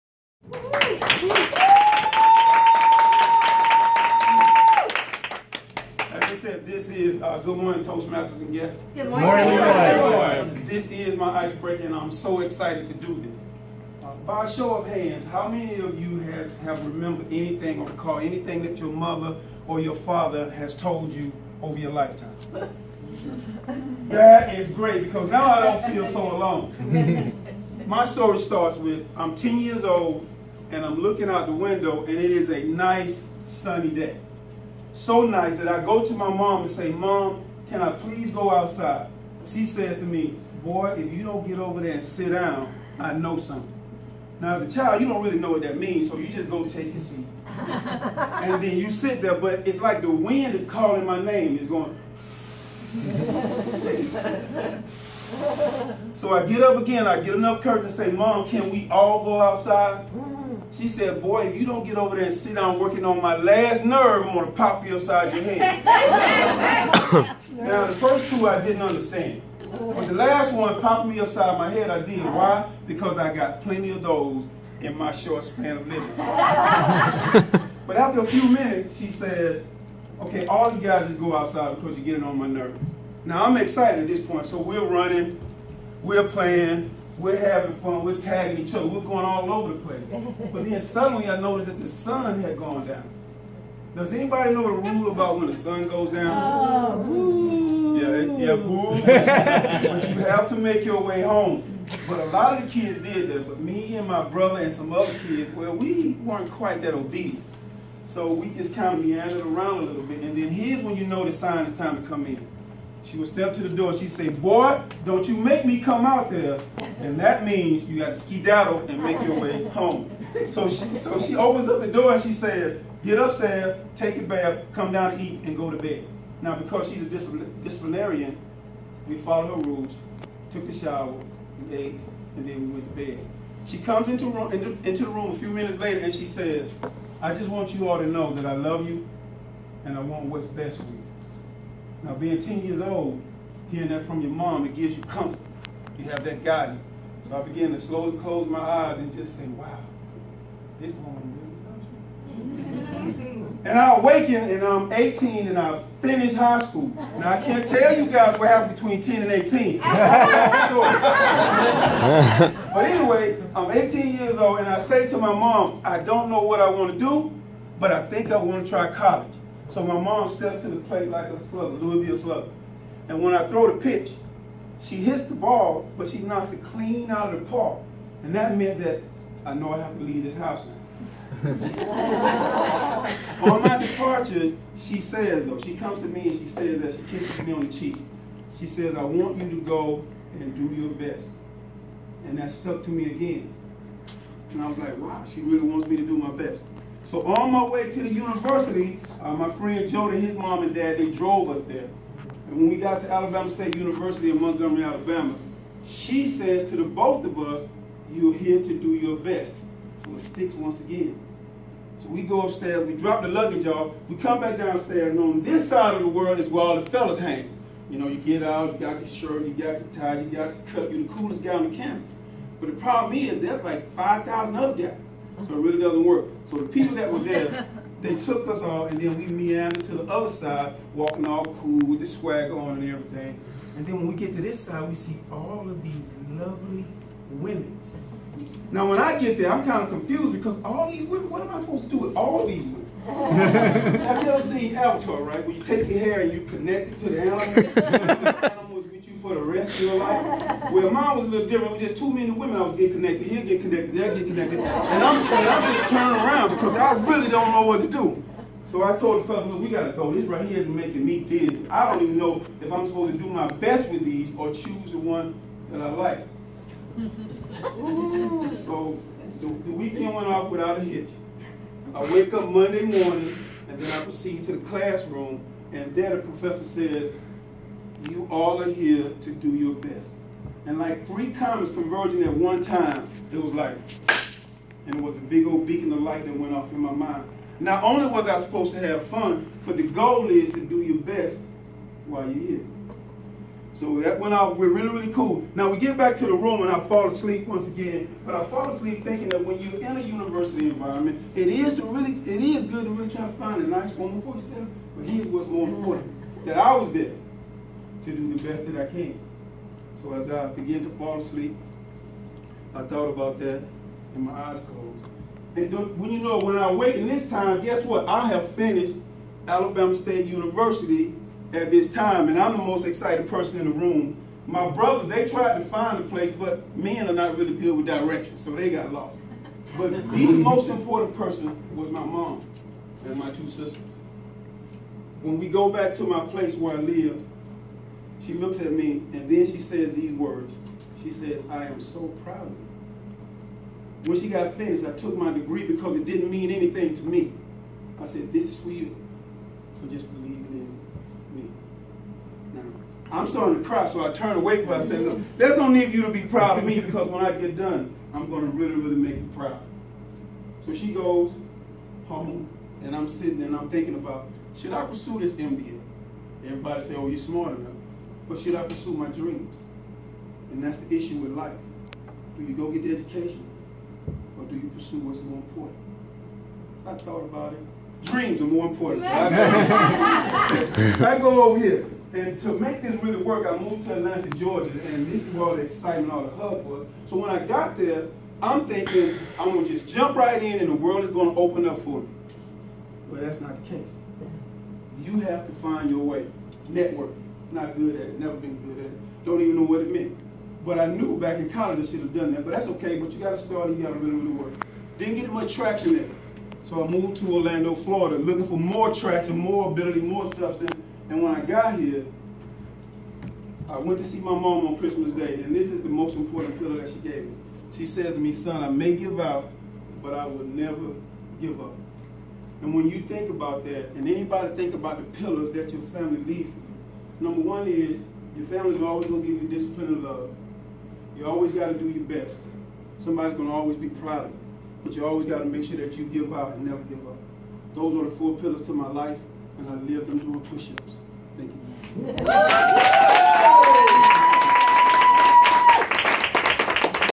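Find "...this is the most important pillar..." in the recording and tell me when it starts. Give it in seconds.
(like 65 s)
415 s.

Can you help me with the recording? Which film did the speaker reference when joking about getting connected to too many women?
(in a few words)
Avatar.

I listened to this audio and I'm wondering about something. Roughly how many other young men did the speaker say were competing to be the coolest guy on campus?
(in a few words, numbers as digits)
5,000.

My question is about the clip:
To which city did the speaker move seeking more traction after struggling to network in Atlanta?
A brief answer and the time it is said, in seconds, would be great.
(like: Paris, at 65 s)
Orlando, Florida, at 407 s.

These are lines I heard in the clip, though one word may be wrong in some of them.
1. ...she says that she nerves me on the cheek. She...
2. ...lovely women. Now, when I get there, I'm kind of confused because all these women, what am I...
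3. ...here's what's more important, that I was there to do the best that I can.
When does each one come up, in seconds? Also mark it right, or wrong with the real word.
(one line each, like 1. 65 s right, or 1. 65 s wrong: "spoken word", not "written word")
1. 186 s wrong: "kisses", not "nerves"
2. 236 s right
3. 305 s right.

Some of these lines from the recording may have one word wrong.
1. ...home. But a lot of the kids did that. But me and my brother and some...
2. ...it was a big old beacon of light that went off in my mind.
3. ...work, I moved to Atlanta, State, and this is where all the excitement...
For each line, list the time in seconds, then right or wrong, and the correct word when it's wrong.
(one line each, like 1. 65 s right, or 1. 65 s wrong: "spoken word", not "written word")
1. 101 s right
2. 284 s right
3. 383 s wrong: "Georgia", not "State".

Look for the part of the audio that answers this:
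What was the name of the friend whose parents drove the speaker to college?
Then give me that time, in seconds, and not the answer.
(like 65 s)
199 s.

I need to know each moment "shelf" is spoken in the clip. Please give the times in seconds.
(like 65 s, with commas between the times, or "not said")
not said.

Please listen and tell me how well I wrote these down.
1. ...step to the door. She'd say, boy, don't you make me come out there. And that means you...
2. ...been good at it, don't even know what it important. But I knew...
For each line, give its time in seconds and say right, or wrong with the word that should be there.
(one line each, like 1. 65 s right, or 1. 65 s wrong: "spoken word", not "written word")
1. 113 s right
2. 398 s wrong: "meant", not "important".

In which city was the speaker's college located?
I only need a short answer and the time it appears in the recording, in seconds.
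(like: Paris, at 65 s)
Montgomery, Alabama, at 204 s.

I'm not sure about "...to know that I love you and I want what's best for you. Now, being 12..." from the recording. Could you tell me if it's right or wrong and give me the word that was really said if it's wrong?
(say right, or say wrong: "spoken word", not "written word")
wrong: "10", not "12".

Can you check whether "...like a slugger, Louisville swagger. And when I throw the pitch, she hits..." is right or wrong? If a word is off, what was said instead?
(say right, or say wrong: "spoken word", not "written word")
wrong: "slugger", not "swagger".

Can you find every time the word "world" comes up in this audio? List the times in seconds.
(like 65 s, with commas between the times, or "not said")
216 s, 390 s.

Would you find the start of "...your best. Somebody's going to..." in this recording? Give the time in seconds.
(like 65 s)
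431 s.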